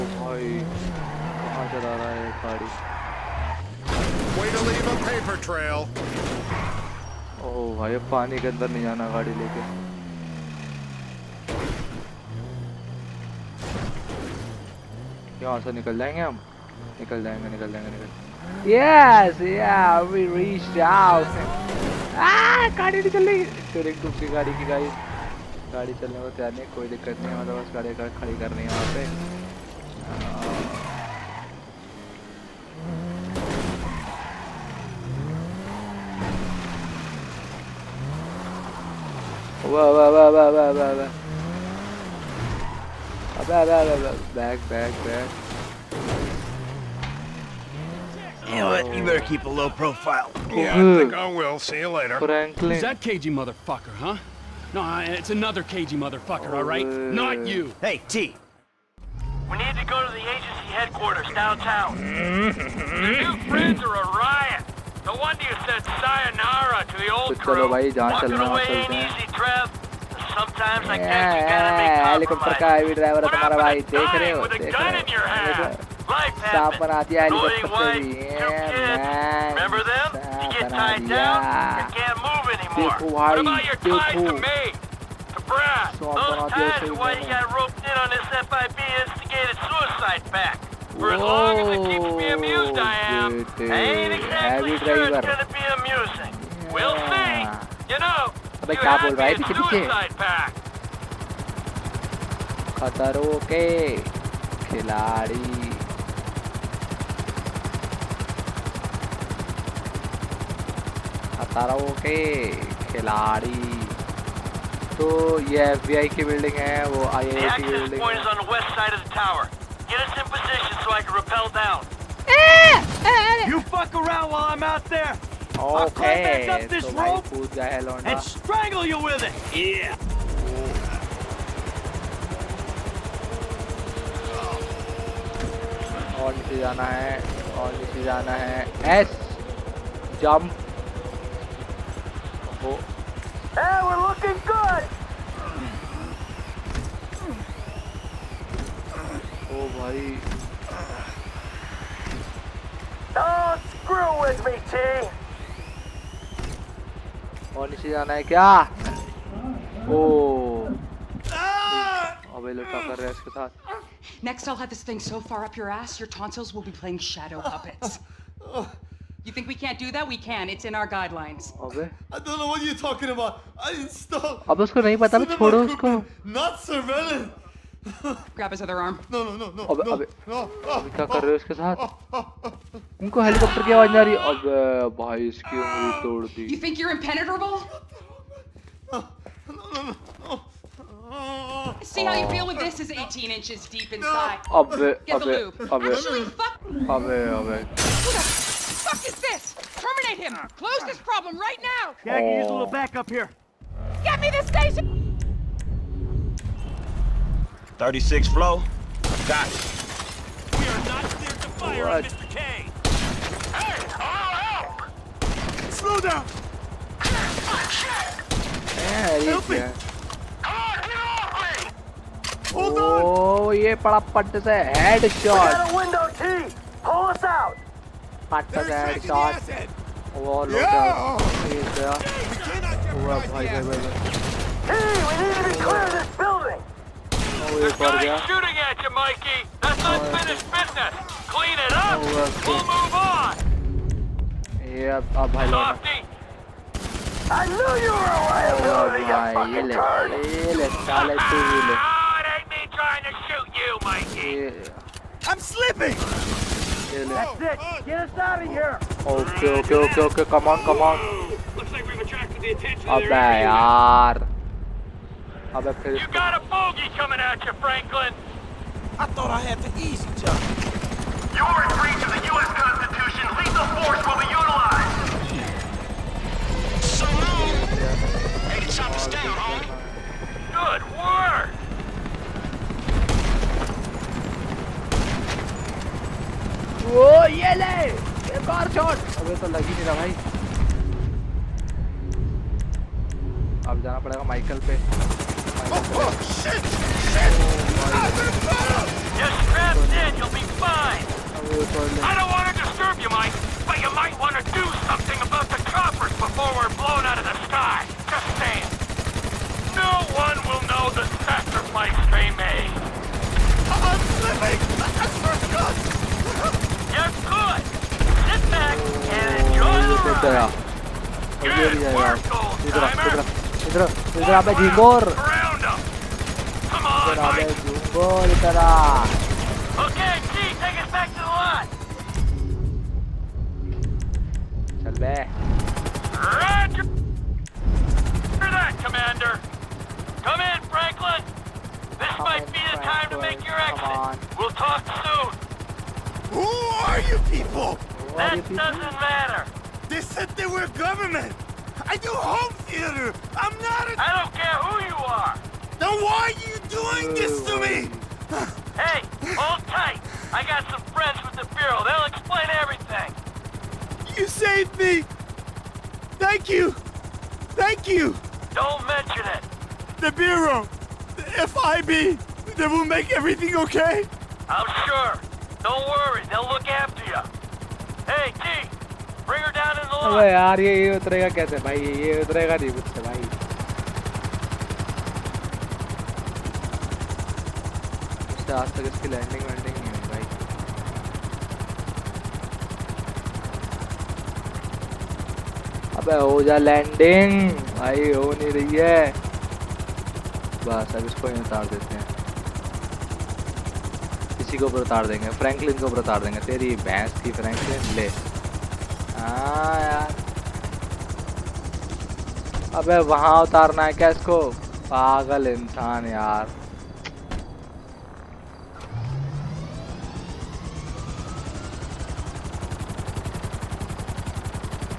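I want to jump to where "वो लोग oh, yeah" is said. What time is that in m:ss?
3:50.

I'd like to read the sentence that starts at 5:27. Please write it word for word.
Goalie, Okay, G, take us back to the lot.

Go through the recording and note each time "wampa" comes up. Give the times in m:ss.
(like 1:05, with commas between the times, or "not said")
not said.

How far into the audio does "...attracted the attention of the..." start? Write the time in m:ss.
4:21.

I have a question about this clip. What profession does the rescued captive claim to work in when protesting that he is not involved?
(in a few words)
Home theater.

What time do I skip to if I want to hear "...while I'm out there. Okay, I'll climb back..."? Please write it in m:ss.
2:04.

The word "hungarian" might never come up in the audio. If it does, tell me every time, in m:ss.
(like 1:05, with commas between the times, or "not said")
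not said.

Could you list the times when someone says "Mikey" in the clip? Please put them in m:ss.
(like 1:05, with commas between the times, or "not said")
3:58, 4:13.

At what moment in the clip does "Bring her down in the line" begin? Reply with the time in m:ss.
6:19.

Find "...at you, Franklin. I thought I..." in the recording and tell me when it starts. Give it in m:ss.
4:27.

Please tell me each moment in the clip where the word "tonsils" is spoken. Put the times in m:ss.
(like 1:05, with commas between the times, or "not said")
2:46.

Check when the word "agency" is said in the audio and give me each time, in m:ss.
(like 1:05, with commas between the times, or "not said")
1:00.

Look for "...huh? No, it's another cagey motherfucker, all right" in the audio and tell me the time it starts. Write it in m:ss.
0:53.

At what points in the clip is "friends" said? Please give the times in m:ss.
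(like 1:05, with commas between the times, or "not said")
1:03, 6:00.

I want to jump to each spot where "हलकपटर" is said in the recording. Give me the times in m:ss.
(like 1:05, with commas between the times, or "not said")
1:12, 1:17, 3:03.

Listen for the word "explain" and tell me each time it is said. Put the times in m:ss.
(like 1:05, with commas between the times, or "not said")
6:02.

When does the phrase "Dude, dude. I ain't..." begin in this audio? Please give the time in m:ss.
1:33.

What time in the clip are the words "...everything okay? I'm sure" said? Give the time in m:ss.
6:13.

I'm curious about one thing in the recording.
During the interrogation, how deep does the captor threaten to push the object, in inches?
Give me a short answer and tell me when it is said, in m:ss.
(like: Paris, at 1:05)
18 inches, at 3:12.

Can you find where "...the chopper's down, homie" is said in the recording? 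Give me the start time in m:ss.
4:38.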